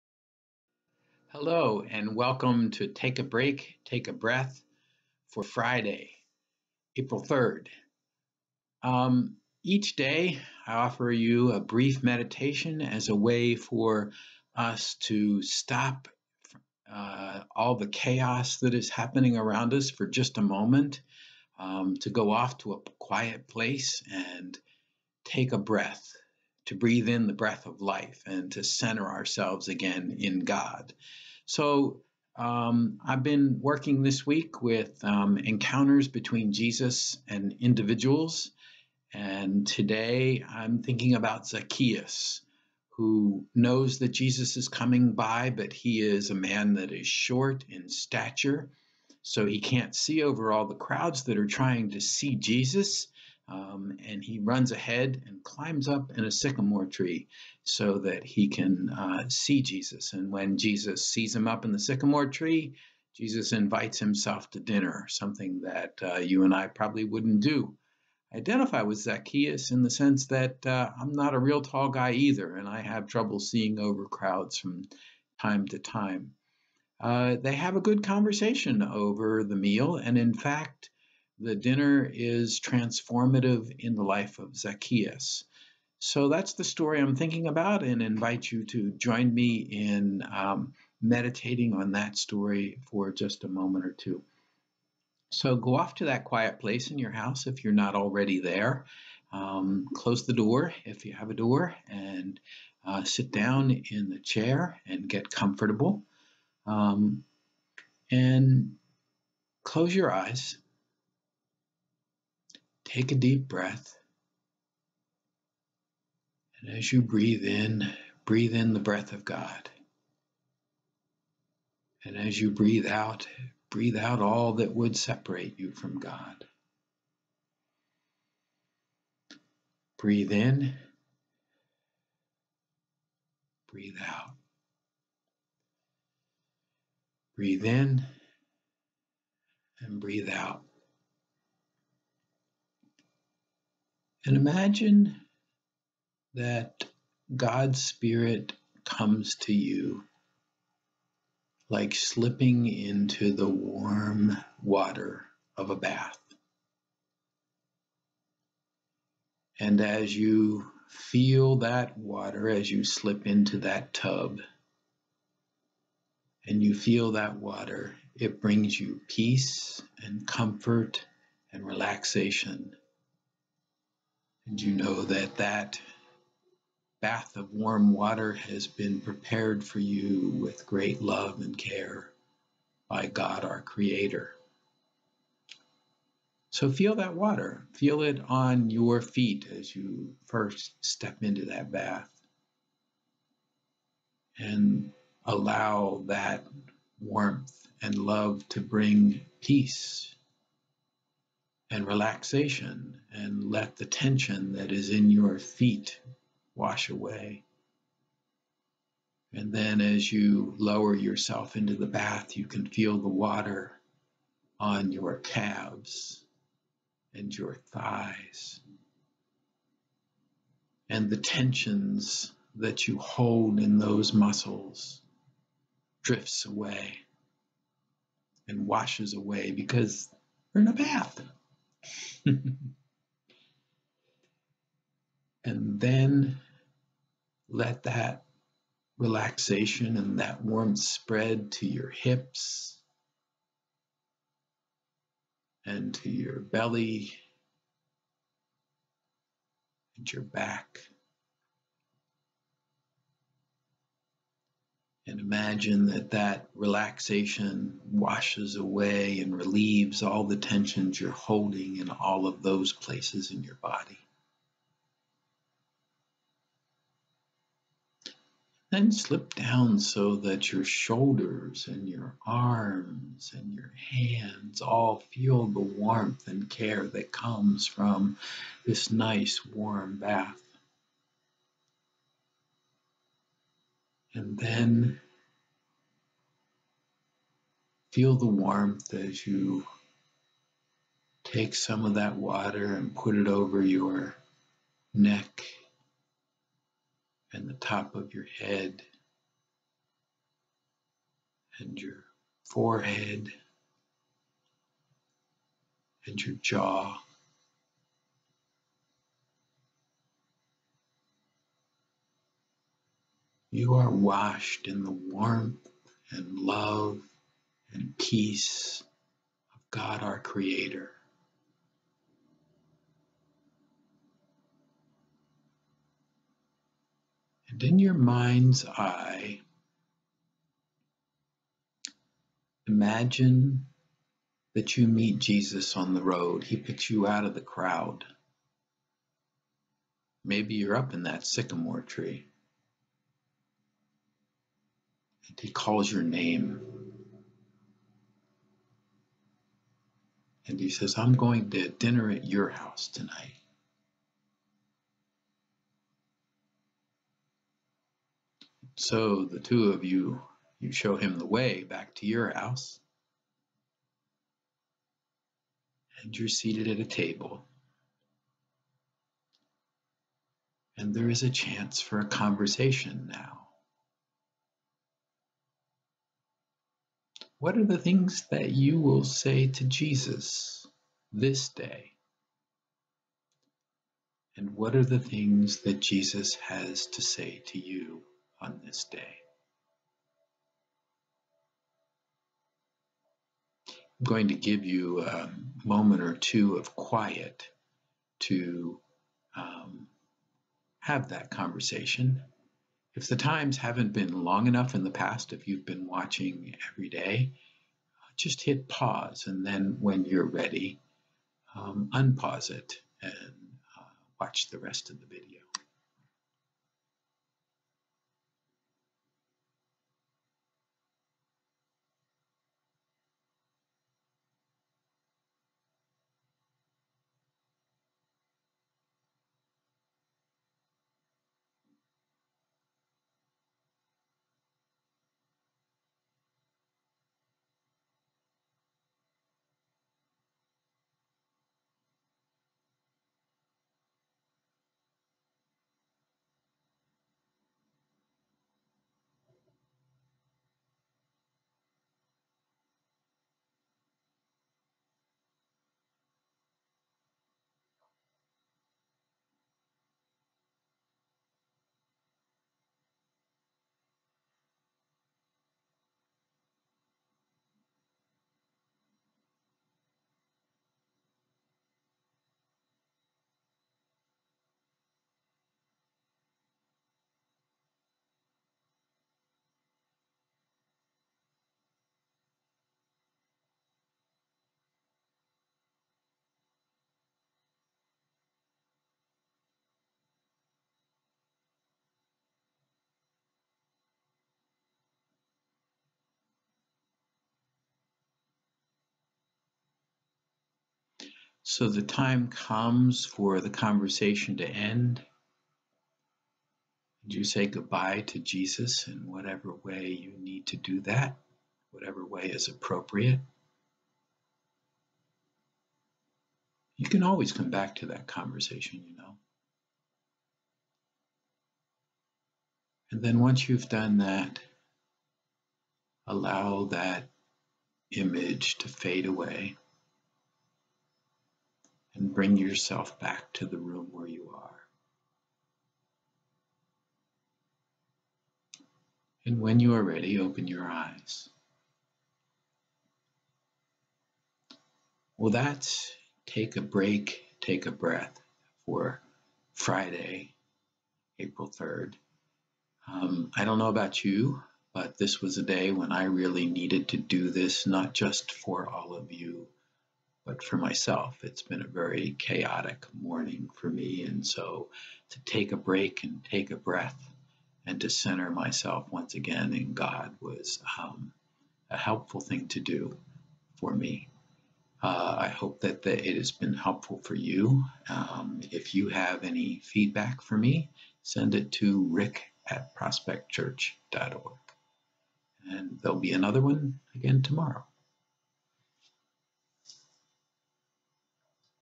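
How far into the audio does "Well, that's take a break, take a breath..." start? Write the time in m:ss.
9:05.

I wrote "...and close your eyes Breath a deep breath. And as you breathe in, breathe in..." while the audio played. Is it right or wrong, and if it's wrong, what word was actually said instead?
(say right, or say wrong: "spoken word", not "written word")
wrong: "Take", not "Breath".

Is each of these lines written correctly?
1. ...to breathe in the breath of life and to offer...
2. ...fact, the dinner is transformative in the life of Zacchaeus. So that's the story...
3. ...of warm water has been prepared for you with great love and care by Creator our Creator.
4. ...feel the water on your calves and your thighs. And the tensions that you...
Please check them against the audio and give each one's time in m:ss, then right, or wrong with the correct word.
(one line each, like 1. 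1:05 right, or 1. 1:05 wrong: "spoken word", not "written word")
1. 0:26 wrong: "center", not "offer"
2. 1:20 right
3. 2:57 wrong: "God", not "Creator"
4. 3:32 right.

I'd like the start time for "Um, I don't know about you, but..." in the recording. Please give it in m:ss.
9:12.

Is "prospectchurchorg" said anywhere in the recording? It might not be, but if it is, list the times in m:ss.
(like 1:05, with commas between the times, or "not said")
9:42.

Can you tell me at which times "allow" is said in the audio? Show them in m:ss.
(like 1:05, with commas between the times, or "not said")
3:15, 8:46.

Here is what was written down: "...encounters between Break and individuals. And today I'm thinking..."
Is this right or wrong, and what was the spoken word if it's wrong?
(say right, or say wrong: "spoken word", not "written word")
wrong: "Jesus", not "Break".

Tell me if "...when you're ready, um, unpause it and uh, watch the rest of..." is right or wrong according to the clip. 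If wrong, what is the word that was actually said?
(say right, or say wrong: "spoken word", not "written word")
right.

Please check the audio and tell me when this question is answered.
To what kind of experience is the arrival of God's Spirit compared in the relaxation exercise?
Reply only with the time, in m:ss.
2:33.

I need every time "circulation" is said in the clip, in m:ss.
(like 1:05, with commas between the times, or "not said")
not said.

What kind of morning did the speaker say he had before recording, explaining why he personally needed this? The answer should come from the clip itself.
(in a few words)
Chaotic.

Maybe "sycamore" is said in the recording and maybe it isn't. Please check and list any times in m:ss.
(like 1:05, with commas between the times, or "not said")
0:56, 1:01, 5:41.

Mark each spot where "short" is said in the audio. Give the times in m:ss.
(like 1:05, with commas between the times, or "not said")
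0:47.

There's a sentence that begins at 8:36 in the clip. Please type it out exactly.
You can always come back to that conversation, you know.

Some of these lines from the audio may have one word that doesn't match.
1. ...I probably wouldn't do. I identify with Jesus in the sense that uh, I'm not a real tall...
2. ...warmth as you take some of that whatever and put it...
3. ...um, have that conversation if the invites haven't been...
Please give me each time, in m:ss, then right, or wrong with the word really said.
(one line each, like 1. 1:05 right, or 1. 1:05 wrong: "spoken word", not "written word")
1. 1:06 wrong: "Zacchaeus", not "Jesus"
2. 4:48 wrong: "water", not "whatever"
3. 6:39 wrong: "times", not "invites".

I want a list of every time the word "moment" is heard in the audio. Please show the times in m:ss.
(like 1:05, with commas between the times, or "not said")
0:20, 1:33, 6:35.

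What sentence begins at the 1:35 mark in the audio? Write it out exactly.
So go off to that quiet place in your house if you're not already there.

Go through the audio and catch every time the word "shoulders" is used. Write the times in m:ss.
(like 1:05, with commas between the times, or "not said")
4:30.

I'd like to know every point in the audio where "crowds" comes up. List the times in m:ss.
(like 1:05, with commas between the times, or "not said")
0:50, 1:14, 5:37.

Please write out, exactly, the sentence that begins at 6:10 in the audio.
And there is a chance for a conversation now.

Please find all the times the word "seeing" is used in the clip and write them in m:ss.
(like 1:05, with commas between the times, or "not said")
1:13.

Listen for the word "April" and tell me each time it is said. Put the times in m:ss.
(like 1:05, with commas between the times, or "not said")
0:06, 9:11.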